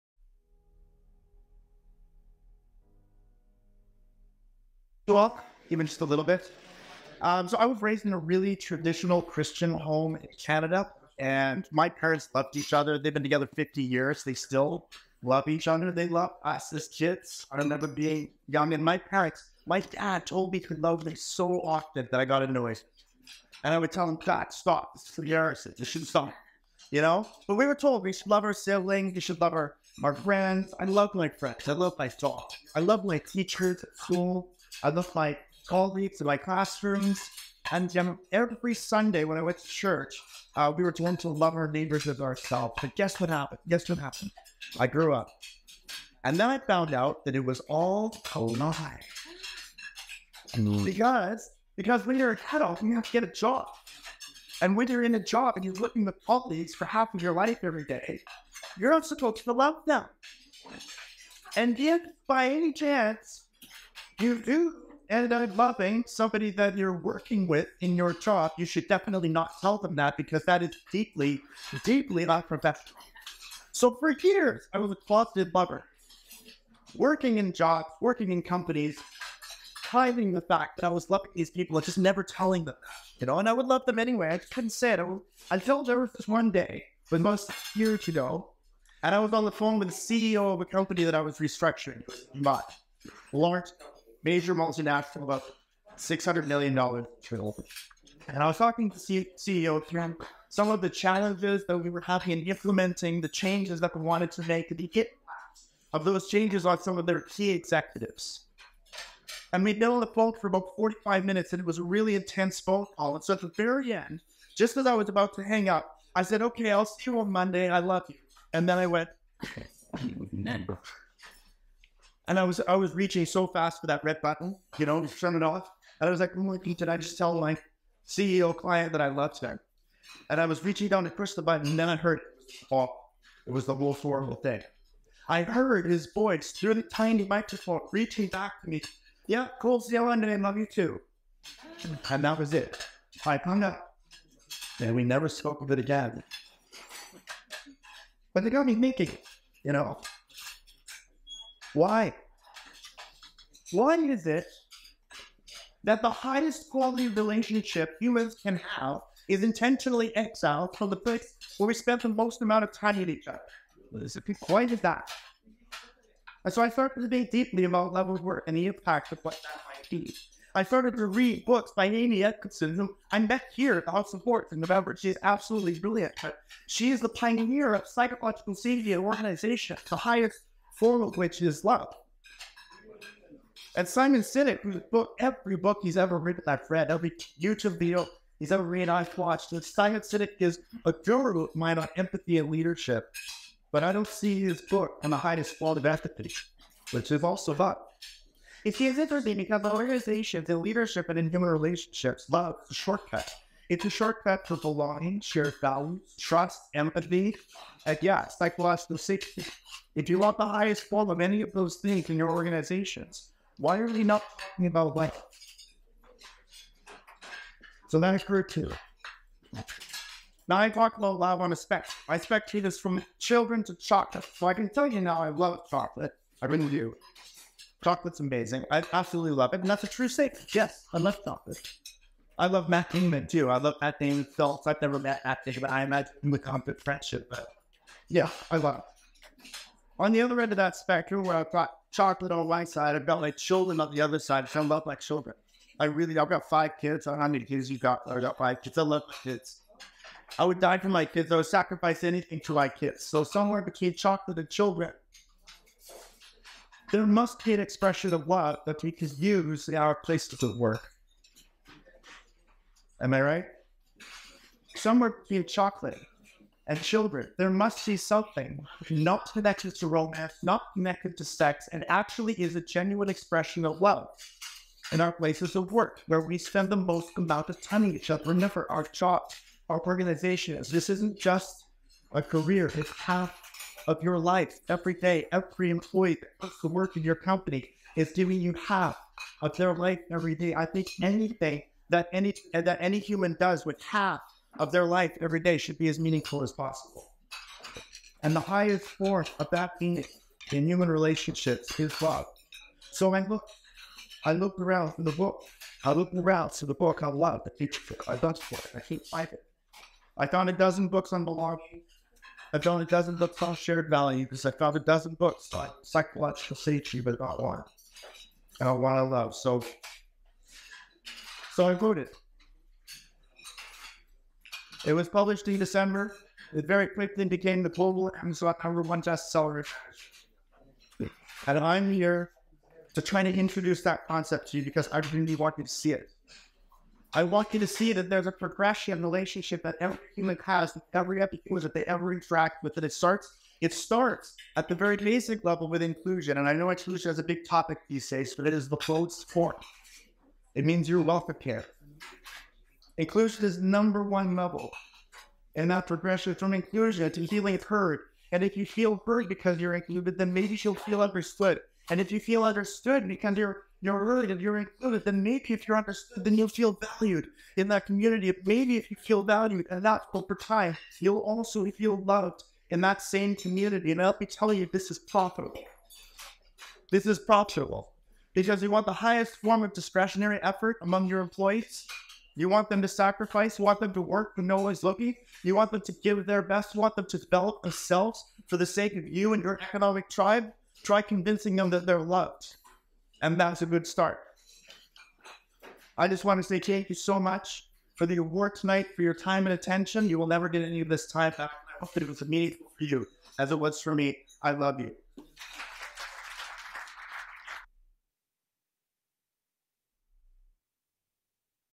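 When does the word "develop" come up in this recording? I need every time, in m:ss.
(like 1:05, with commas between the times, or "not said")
6:27.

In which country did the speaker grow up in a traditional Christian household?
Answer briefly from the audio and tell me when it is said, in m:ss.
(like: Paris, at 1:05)
Canada, at 0:10.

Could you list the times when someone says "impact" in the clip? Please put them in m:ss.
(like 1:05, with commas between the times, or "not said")
2:48.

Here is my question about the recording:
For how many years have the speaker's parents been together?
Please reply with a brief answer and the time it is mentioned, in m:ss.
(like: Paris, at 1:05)
50, at 0:13.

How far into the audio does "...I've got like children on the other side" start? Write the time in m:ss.
4:02.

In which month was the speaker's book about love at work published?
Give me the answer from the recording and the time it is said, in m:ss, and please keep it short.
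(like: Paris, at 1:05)
December, at 5:25.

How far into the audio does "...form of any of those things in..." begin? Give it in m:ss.
3:30.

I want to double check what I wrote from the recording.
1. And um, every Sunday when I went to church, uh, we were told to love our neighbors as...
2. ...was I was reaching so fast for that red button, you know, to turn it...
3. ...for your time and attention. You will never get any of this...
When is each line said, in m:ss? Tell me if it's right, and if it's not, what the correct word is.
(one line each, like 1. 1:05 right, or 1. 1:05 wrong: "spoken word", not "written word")
1. 0:37 right
2. 2:02 right
3. 6:38 right.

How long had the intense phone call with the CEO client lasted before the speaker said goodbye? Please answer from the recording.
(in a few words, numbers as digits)
45 minutes.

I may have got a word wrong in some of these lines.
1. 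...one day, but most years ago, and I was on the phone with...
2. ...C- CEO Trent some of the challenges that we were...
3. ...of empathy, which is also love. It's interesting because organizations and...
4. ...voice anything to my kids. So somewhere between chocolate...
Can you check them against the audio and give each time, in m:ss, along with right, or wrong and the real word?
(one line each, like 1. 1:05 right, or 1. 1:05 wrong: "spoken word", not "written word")
1. 1:26 right
2. 1:38 right
3. 3:15 right
4. 4:11 wrong: "sacrifice", not "voice".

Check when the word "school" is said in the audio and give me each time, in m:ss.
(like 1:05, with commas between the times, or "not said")
0:33.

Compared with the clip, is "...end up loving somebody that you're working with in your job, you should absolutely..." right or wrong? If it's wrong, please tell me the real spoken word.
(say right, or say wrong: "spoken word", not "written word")
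wrong: "definitely", not "absolutely".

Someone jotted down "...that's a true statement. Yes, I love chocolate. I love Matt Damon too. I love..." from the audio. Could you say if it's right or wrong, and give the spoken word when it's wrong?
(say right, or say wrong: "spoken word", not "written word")
right.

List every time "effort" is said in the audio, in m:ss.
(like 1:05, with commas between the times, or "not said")
6:20.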